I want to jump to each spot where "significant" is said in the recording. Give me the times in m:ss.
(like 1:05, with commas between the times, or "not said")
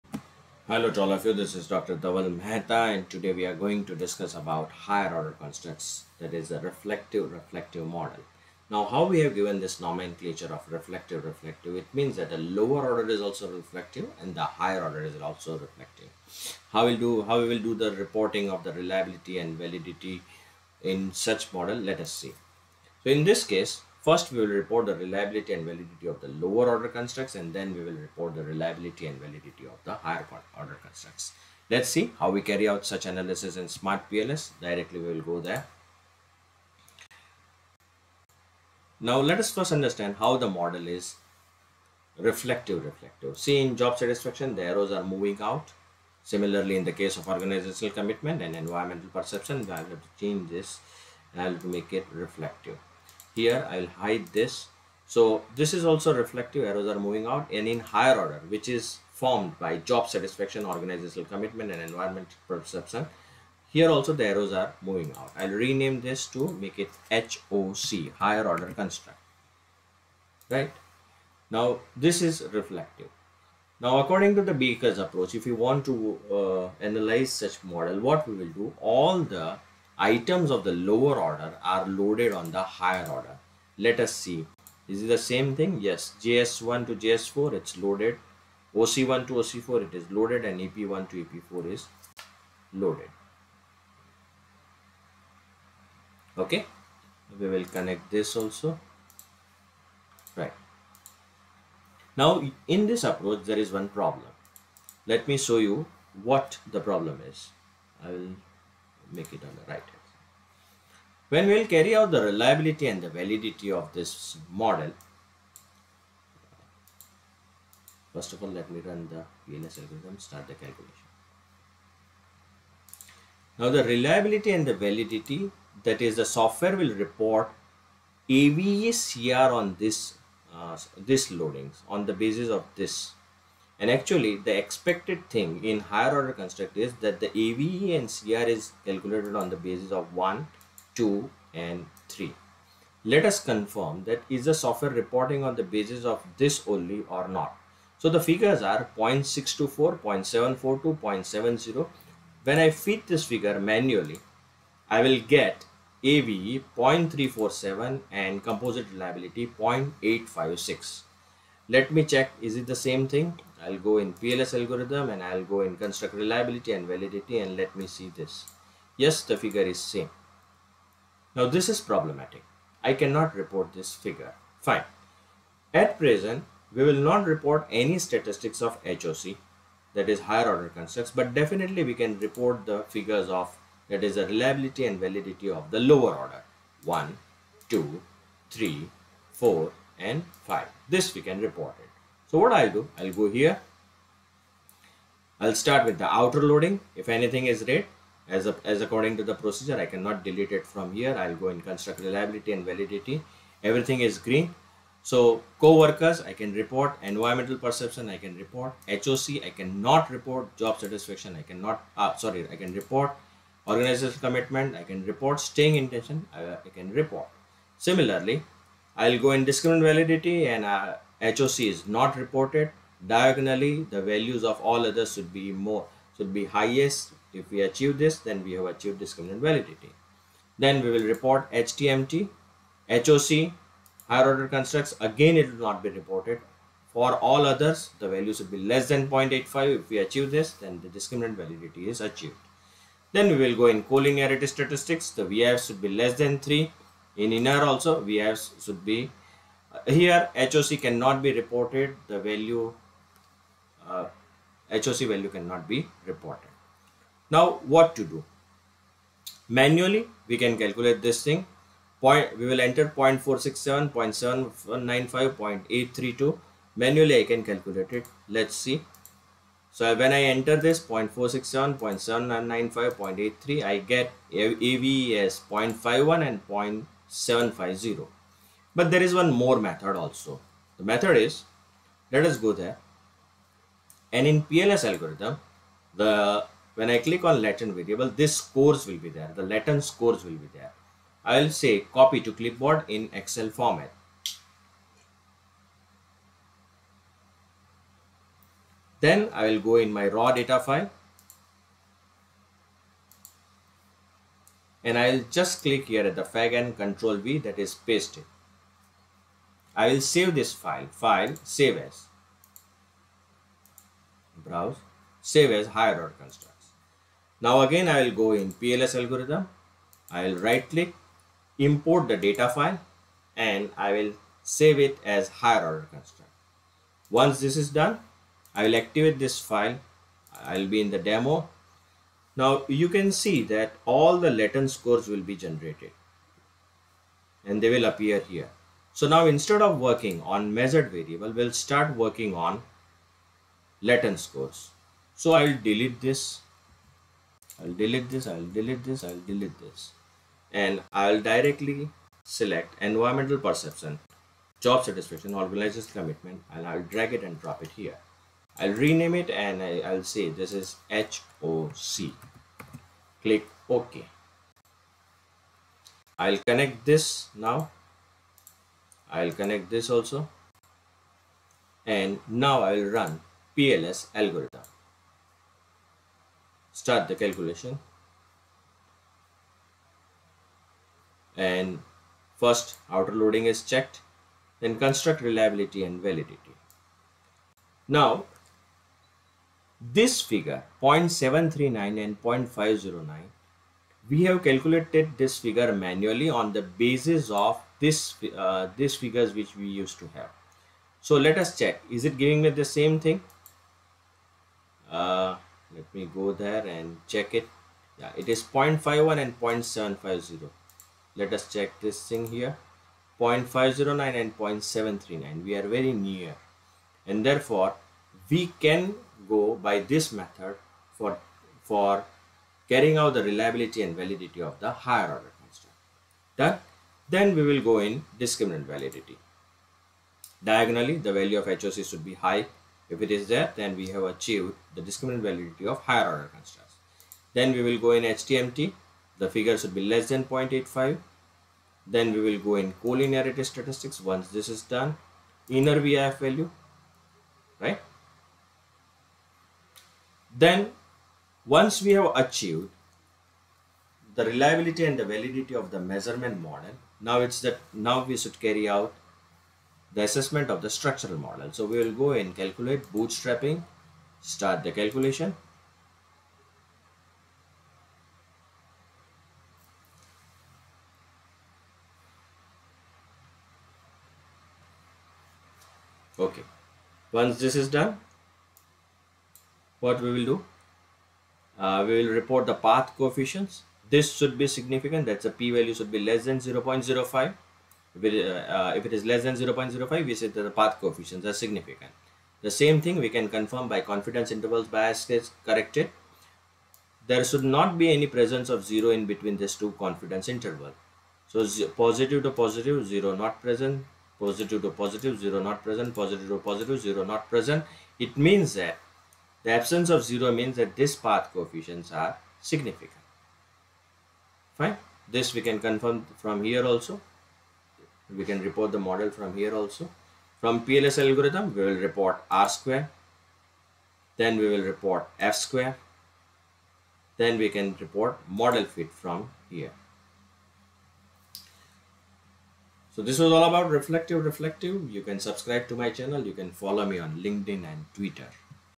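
8:04, 8:11, 8:32.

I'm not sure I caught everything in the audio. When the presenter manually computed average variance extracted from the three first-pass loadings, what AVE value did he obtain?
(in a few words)
0.347.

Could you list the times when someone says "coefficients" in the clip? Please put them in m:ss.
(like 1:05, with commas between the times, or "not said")
8:02, 8:10, 8:31.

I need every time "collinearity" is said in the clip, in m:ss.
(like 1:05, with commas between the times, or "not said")
4:03, 7:22.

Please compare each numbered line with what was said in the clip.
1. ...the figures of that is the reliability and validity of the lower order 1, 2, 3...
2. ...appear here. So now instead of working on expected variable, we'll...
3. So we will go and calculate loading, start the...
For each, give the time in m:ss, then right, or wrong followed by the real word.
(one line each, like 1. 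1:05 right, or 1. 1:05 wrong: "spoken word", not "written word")
1. 3:02 right
2. 5:37 wrong: "measured", not "expected"
3. 7:41 wrong: "bootstrapping", not "loading".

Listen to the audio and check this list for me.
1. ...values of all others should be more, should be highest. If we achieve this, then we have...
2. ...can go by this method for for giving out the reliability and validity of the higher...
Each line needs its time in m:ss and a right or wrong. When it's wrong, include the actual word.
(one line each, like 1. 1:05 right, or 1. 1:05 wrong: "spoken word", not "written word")
1. 3:44 right
2. 6:58 wrong: "carrying", not "giving".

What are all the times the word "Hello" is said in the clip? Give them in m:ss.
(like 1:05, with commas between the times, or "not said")
0:00.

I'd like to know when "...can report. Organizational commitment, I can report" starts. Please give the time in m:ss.
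3:32.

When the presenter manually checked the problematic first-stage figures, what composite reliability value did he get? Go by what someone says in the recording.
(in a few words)
0.856.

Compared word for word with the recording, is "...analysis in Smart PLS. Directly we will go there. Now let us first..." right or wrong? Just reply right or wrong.
right.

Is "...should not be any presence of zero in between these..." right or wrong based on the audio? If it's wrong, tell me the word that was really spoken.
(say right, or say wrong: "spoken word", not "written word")
right.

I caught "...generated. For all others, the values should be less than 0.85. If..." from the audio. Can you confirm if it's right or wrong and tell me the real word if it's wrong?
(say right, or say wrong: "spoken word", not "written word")
wrong: "reported", not "generated".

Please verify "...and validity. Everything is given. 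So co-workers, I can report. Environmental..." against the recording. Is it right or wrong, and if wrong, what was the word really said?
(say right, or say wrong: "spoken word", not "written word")
wrong: "green", not "given".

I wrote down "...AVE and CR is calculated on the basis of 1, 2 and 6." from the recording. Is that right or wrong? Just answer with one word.
wrong.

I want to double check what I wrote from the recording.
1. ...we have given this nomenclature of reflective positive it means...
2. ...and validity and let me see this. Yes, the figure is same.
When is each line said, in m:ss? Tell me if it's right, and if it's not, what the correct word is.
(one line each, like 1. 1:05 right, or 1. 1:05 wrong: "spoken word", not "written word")
1. 0:09 wrong: "reflective", not "positive"
2. 2:46 right.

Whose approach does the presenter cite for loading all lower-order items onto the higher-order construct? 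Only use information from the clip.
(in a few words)
Becker.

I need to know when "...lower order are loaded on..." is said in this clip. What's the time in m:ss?
1:20.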